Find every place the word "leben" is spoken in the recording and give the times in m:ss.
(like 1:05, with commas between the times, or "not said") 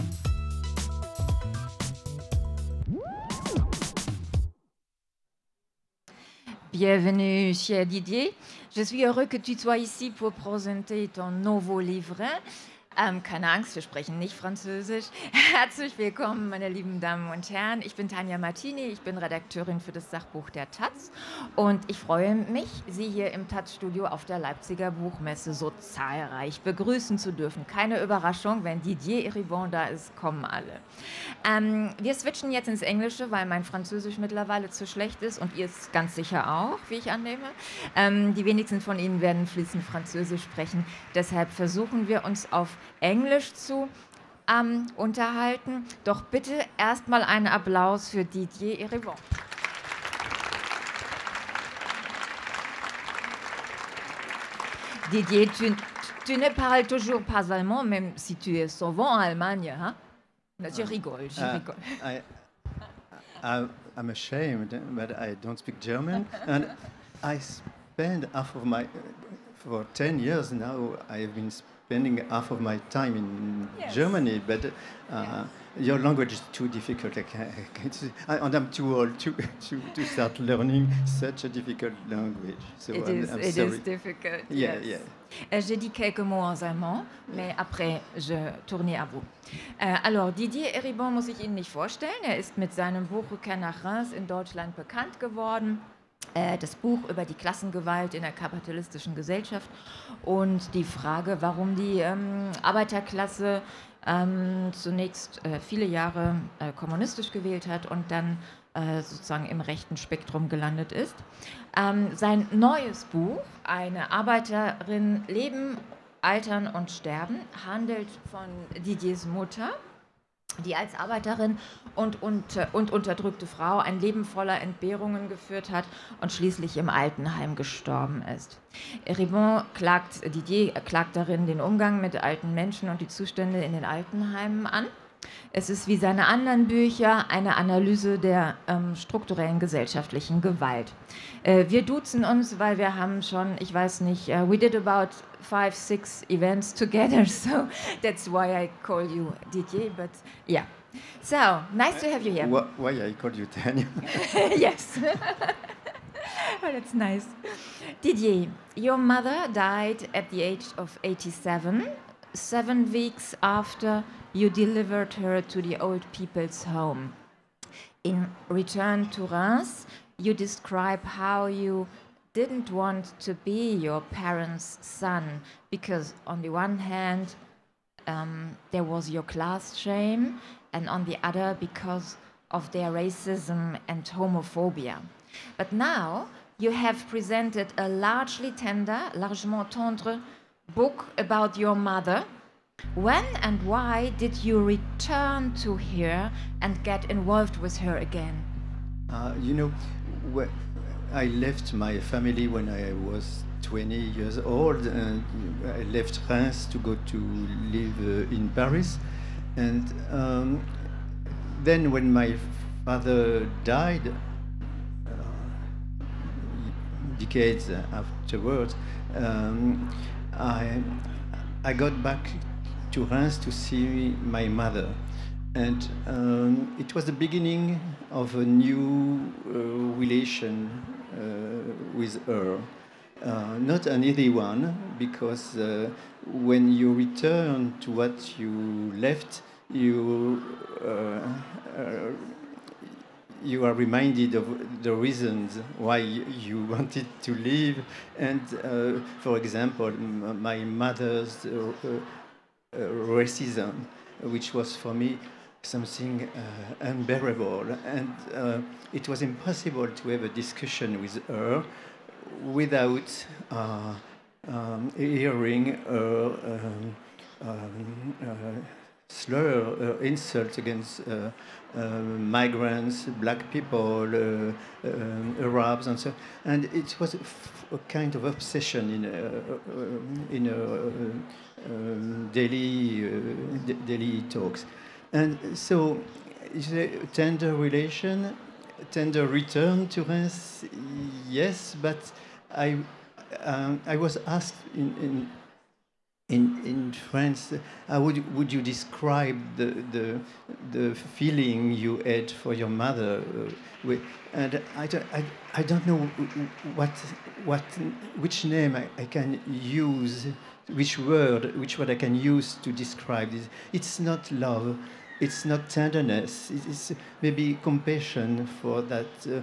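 1:55, 2:04.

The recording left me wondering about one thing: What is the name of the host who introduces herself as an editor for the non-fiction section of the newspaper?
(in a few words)
Tanja Martini.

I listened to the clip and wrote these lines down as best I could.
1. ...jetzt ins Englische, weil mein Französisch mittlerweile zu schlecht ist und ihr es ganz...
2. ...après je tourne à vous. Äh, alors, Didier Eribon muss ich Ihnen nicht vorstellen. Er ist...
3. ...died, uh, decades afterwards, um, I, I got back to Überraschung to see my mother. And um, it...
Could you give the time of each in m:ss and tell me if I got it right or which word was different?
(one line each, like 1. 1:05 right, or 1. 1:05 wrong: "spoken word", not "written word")
1. 0:32 right
2. 1:27 right
3. 3:33 wrong: "Reims", not "Überraschung".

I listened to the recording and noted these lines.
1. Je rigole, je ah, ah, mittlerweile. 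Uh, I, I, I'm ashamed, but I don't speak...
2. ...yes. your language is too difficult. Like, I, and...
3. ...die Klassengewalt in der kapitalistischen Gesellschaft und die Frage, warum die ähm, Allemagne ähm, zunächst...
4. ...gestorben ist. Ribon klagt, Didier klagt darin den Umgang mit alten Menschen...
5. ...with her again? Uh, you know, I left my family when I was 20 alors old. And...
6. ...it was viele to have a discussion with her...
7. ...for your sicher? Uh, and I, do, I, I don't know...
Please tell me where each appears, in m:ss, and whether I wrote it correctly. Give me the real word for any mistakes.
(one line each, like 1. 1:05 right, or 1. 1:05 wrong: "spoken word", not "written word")
1. 1:00 wrong: "rigole", not "mittlerweile"
2. 1:15 right
3. 1:37 wrong: "Arbeiterklasse", not "Allemagne"
4. 2:07 right
5. 3:17 wrong: "years", not "alors"
6. 4:18 wrong: "impossible", not "viele"
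7. 5:02 wrong: "mother", not "sicher".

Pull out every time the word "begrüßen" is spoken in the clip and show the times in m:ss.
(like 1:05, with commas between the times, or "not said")
0:26.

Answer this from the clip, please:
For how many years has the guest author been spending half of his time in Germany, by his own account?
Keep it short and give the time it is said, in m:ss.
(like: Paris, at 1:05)
10, at 1:09.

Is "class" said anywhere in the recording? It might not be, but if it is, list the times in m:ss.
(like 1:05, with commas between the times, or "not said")
2:59.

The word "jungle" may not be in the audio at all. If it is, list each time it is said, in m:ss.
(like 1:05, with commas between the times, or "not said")
not said.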